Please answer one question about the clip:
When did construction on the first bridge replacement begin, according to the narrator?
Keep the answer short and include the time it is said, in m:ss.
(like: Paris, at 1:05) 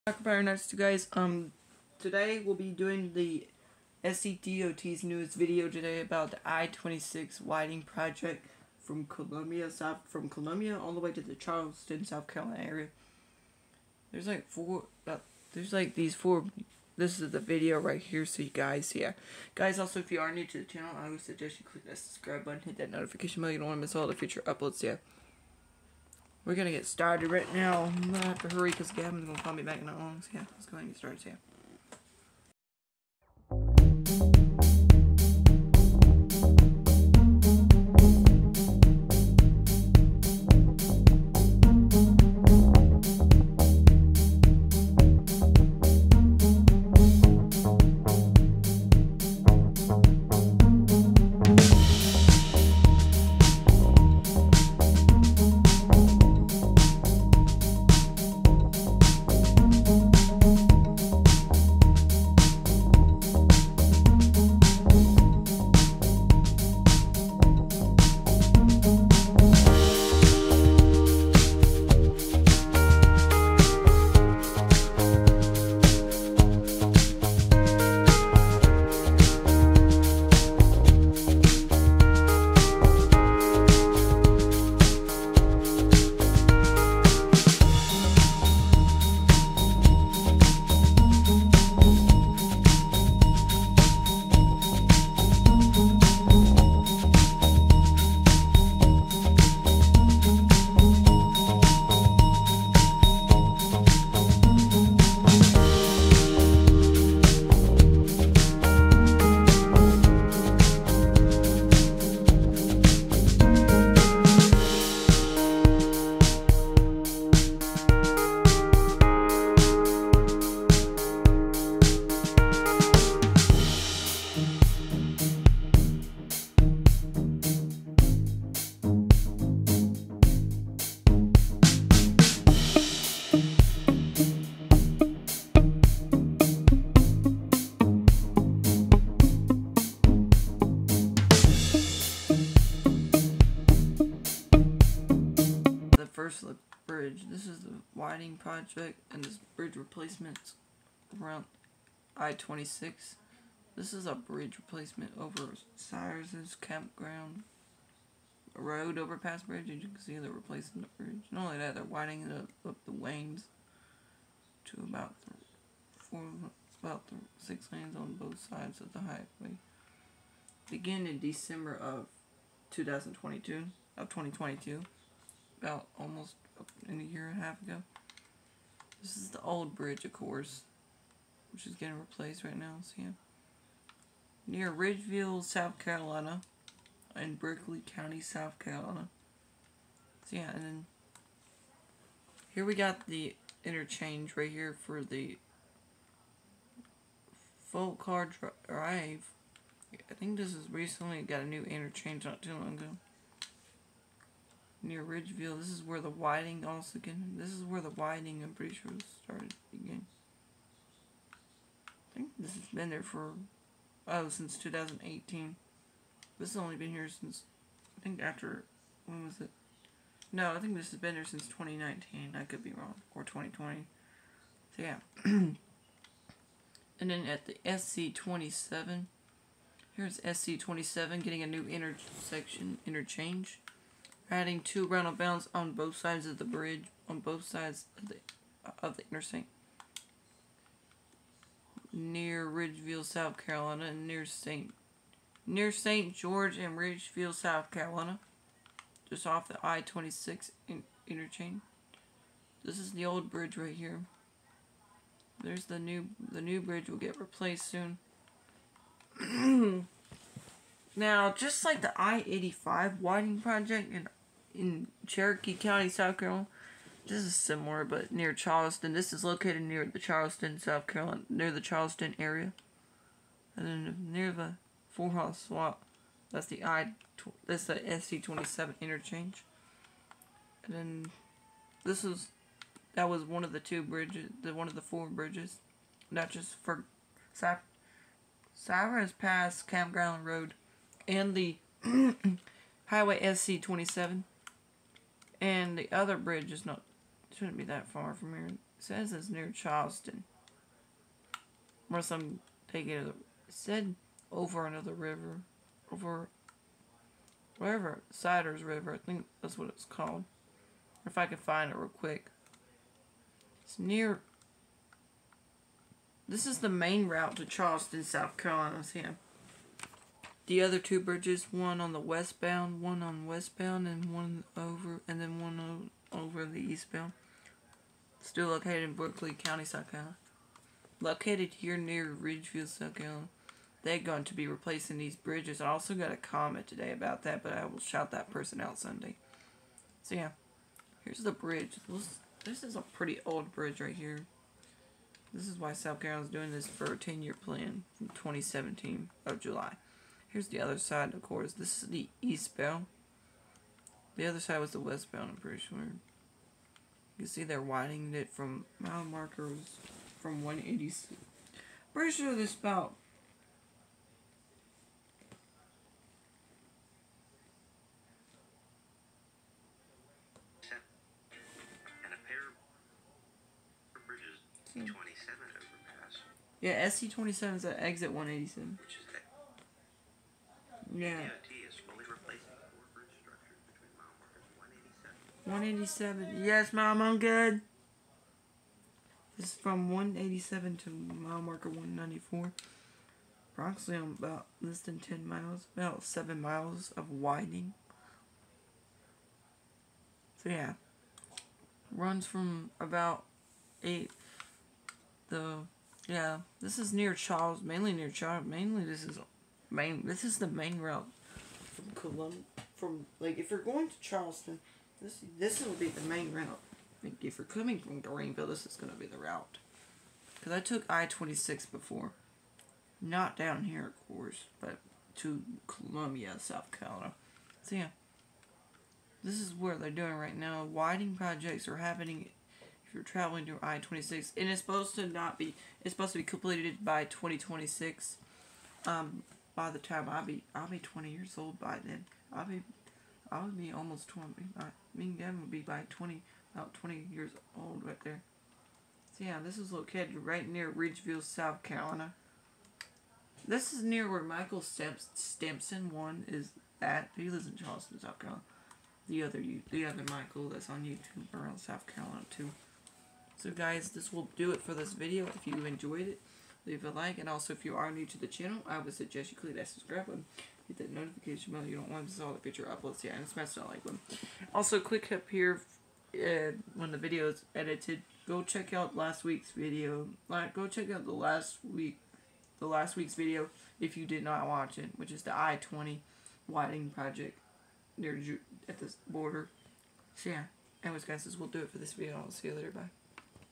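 December 2022, at 2:51.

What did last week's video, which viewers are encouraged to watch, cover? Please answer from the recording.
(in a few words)
I-20 widening project.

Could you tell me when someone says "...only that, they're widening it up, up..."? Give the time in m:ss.
2:41.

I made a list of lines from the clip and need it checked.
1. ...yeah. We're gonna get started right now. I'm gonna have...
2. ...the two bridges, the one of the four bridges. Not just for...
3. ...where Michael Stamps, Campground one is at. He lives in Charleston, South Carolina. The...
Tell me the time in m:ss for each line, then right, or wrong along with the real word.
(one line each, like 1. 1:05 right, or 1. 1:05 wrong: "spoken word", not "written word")
1. 0:24 right
2. 4:43 right
3. 7:34 wrong: "Stampson", not "Campground".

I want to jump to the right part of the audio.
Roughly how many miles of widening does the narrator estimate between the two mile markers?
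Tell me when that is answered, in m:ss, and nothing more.
6:35.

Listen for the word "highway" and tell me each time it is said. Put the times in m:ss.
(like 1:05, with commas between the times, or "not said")
2:48, 4:52.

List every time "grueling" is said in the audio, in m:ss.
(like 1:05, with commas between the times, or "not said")
not said.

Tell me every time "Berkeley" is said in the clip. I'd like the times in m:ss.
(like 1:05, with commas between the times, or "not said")
3:07, 5:28.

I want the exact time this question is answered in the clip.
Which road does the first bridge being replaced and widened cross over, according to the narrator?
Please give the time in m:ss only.
2:35.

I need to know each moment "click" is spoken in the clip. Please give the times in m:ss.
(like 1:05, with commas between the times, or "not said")
0:21, 7:49, 7:54.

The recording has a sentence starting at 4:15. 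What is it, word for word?
There's the new, the new bridge will get replaced soon.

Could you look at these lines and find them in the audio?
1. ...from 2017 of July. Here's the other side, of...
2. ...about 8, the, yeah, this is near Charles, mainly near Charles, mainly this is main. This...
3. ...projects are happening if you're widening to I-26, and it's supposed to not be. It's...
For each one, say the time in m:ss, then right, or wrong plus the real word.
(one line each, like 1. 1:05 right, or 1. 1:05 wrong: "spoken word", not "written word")
1. 5:47 right
2. 6:42 right
3. 7:11 wrong: "traveling", not "widening".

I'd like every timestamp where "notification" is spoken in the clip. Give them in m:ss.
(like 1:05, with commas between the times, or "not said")
0:22, 7:50.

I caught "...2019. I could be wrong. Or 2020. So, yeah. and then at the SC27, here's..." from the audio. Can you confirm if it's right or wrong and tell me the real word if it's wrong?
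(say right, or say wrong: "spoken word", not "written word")
right.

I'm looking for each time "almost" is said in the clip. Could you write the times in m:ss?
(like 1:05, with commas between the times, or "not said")
2:55, 7:23.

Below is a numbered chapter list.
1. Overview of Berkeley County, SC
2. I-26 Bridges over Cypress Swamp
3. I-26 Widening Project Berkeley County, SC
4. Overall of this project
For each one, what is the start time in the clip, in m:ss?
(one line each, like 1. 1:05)
1. 0:10
2. 5:25
3. 2:25
4. 6:40.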